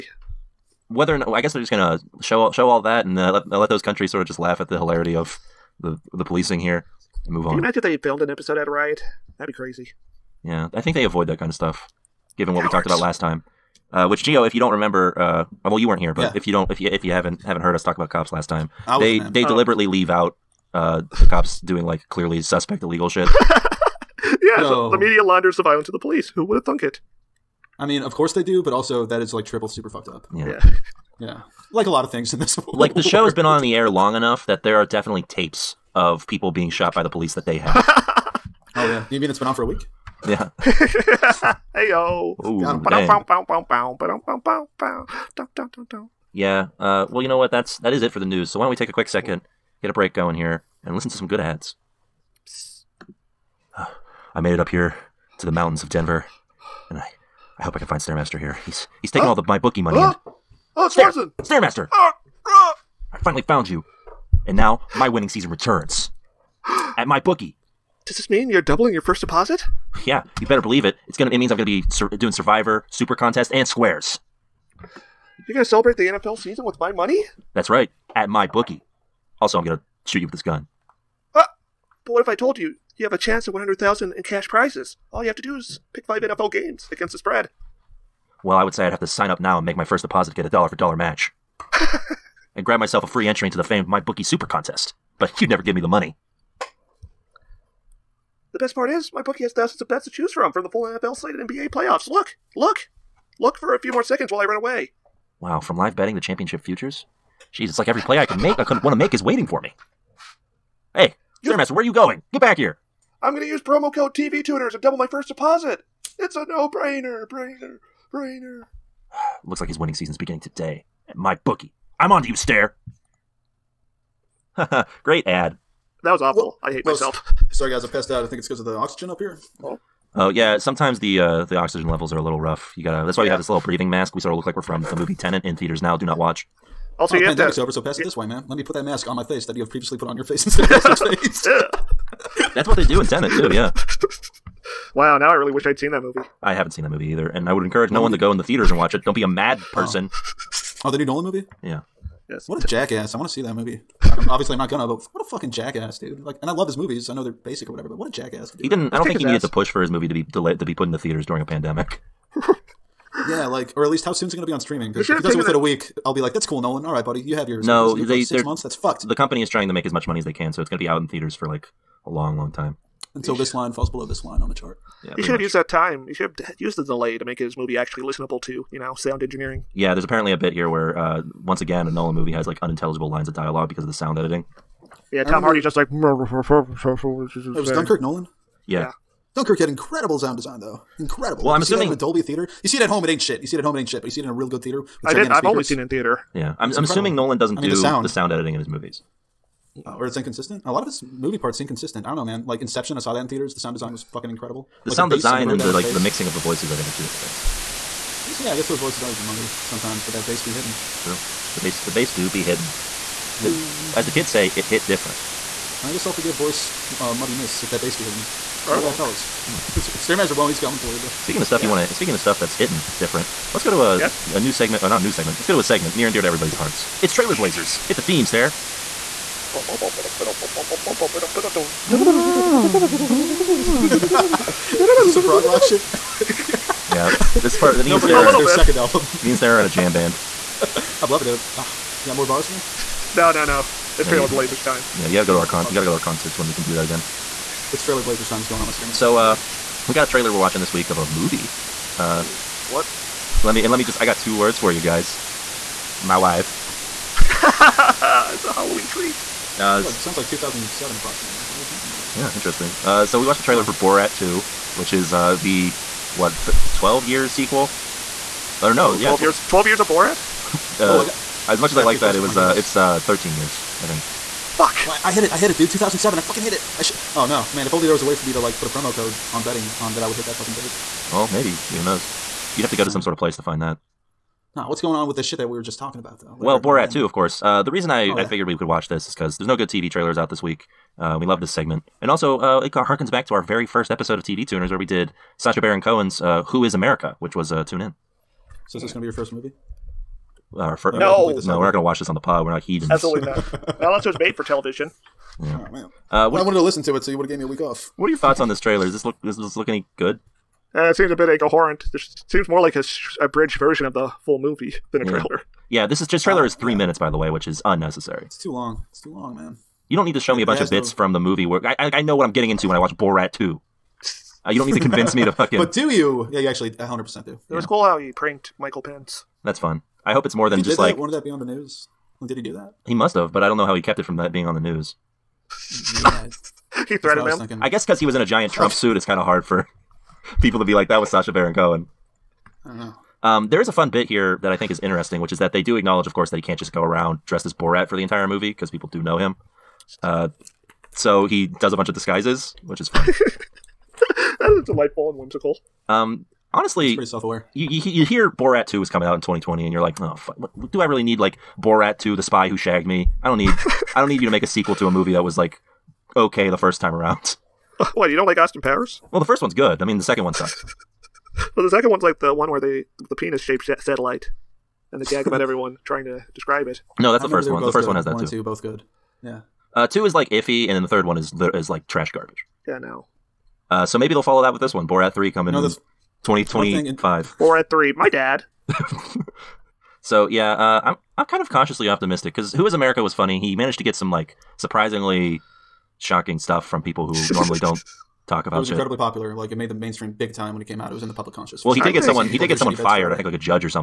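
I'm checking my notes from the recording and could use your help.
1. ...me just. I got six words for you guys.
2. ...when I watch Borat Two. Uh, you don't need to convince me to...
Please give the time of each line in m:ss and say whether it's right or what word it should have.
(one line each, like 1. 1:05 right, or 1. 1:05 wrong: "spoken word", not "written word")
1. 4:13 wrong: "two", not "six"
2. 5:22 right.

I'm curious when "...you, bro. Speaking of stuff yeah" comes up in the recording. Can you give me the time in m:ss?
3:40.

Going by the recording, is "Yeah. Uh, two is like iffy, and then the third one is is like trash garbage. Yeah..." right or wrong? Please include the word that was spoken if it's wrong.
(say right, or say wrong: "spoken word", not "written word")
right.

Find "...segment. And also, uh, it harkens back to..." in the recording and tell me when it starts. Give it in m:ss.
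4:51.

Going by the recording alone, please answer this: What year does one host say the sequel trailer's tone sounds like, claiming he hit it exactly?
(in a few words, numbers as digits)
2007.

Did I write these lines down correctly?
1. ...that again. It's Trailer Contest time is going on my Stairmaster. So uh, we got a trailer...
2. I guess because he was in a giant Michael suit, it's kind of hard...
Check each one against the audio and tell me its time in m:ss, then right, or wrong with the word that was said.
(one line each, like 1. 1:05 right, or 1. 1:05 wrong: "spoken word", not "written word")
1. 4:06 wrong: "Blazers", not "Contest"
2. 5:37 wrong: "Trump", not "Michael".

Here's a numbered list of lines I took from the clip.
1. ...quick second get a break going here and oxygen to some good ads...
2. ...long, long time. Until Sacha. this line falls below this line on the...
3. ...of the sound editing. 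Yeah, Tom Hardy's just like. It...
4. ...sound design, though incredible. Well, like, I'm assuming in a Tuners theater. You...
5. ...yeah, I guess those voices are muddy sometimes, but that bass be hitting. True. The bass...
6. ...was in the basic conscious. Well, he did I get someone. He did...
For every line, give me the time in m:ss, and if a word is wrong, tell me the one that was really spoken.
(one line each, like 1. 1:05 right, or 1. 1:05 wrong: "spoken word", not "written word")
1. 0:48 wrong: "listen", not "oxygen"
2. 2:52 wrong: "Eesh", not "Sacha"
3. 3:03 right
4. 3:10 wrong: "Dolby", not "Tuners"
5. 3:28 right
6. 6:40 wrong: "public", not "basic".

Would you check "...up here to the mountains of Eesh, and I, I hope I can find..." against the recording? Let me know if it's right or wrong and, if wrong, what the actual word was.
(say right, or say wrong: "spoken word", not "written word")
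wrong: "Denver", not "Eesh".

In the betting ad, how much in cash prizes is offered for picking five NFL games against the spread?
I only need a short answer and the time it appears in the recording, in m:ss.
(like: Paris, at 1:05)
100,000, at 1:23.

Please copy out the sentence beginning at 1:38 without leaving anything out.
The best part is, my bookie has thousands of bets to choose from from the full NFL slate and NBA playoffs.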